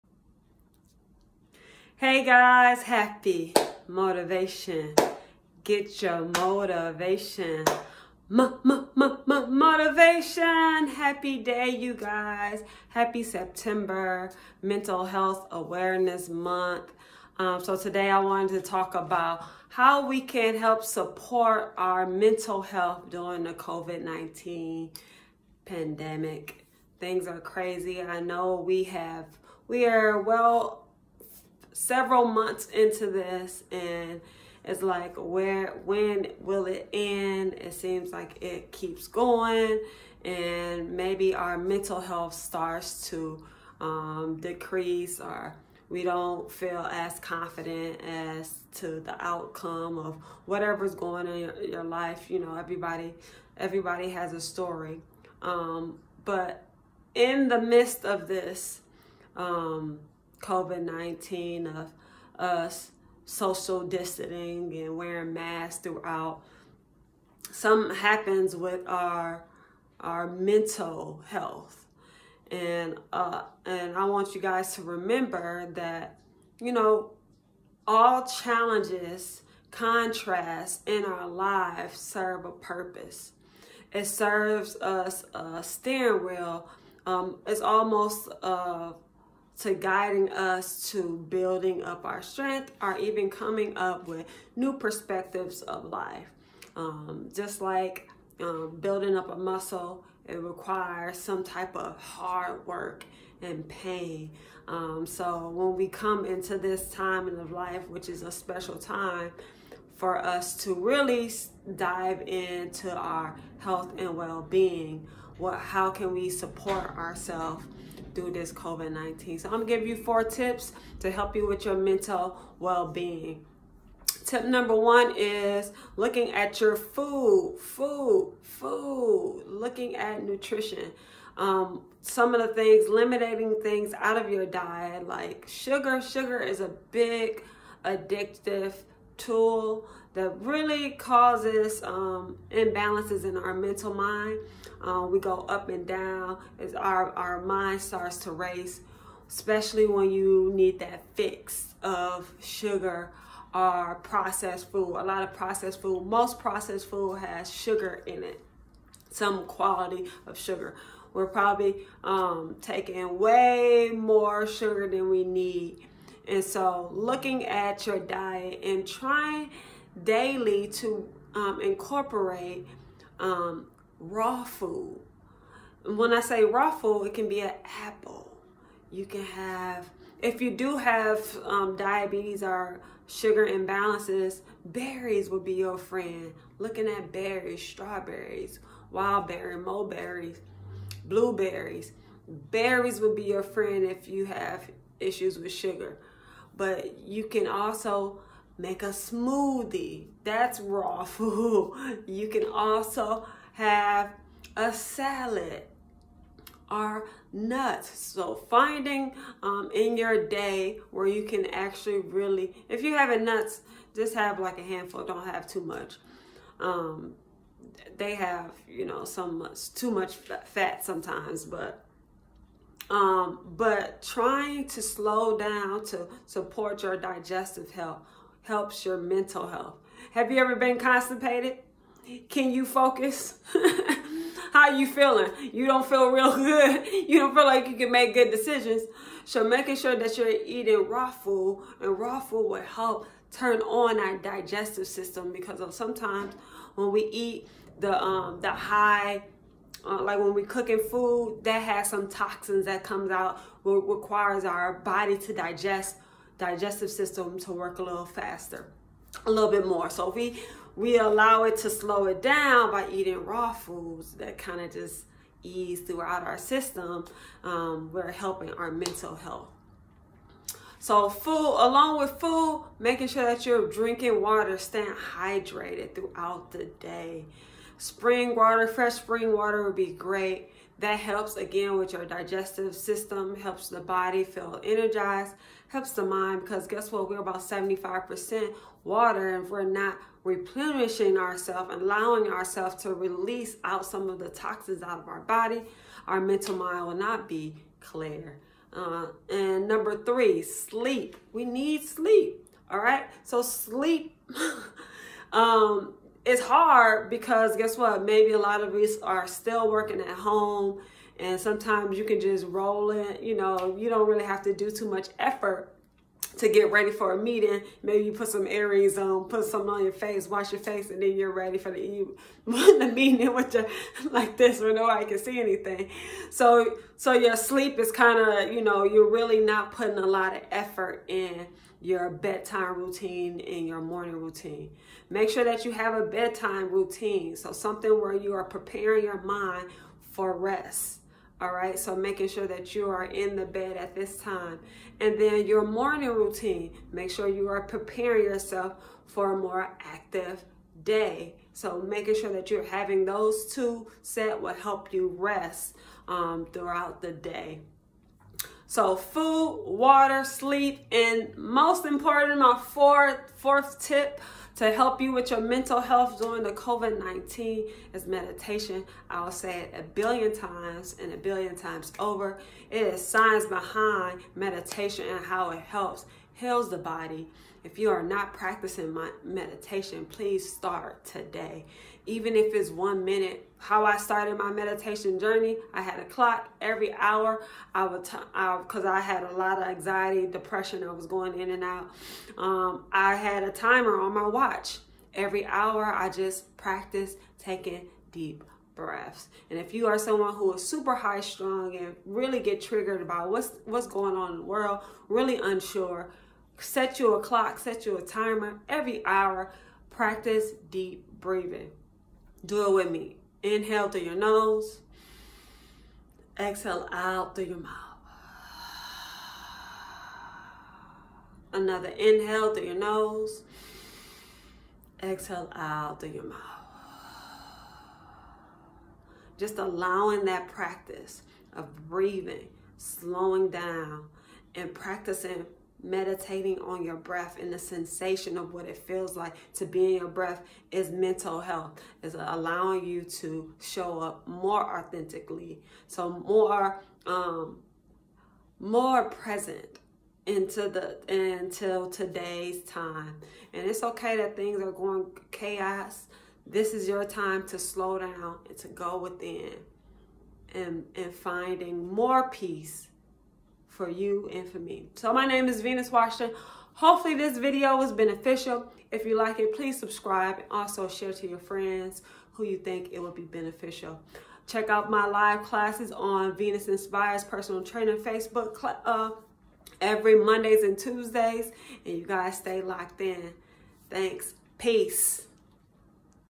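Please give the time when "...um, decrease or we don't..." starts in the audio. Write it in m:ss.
0:43.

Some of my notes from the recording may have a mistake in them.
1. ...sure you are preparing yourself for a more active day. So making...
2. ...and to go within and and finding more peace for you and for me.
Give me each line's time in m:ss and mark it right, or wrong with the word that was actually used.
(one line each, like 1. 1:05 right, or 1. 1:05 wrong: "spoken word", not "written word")
1. 5:47 right
2. 7:38 right.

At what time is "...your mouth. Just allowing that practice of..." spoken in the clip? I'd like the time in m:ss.
7:06.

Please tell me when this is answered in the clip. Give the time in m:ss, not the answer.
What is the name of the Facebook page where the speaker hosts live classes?
7:56.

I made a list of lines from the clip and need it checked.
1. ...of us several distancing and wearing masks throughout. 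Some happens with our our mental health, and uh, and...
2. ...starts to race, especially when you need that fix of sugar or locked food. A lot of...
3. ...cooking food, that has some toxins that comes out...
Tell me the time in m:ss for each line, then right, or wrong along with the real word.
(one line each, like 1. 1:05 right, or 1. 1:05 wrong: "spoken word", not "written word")
1. 1:01 wrong: "social", not "several"
2. 2:27 wrong: "processed", not "locked"
3. 4:10 right.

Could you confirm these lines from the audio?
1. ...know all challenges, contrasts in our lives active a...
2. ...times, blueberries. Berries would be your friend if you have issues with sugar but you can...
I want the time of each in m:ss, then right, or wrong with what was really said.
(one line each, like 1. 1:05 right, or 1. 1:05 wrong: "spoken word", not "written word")
1. 1:16 wrong: "serve", not "active"
2. 3:09 wrong: "mulberries", not "times".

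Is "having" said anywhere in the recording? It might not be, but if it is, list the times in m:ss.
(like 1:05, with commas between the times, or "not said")
3:32, 5:52.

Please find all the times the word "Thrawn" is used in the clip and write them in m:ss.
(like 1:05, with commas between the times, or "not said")
not said.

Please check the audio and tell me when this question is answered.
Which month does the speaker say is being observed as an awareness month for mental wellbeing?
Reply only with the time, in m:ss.
0:13.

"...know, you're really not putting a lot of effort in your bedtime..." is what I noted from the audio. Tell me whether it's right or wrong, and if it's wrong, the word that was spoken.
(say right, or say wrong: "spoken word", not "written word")
right.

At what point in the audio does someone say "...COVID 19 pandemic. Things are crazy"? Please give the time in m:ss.
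0:23.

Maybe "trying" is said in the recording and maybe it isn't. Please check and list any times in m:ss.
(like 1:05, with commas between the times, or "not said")
2:48, 3:44.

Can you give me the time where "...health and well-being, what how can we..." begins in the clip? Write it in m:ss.
1:53.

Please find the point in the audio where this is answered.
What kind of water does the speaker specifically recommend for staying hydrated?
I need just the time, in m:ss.
4:38.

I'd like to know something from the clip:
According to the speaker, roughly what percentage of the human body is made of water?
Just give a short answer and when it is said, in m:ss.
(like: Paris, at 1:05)
75%, at 4:47.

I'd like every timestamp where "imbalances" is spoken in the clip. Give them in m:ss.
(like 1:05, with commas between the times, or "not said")
2:22, 3:03.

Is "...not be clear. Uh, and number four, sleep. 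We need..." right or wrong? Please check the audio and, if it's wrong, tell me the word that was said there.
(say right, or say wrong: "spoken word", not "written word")
wrong: "three", not "four".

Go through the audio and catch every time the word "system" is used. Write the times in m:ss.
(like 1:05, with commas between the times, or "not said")
4:04, 4:16, 4:26, 4:42.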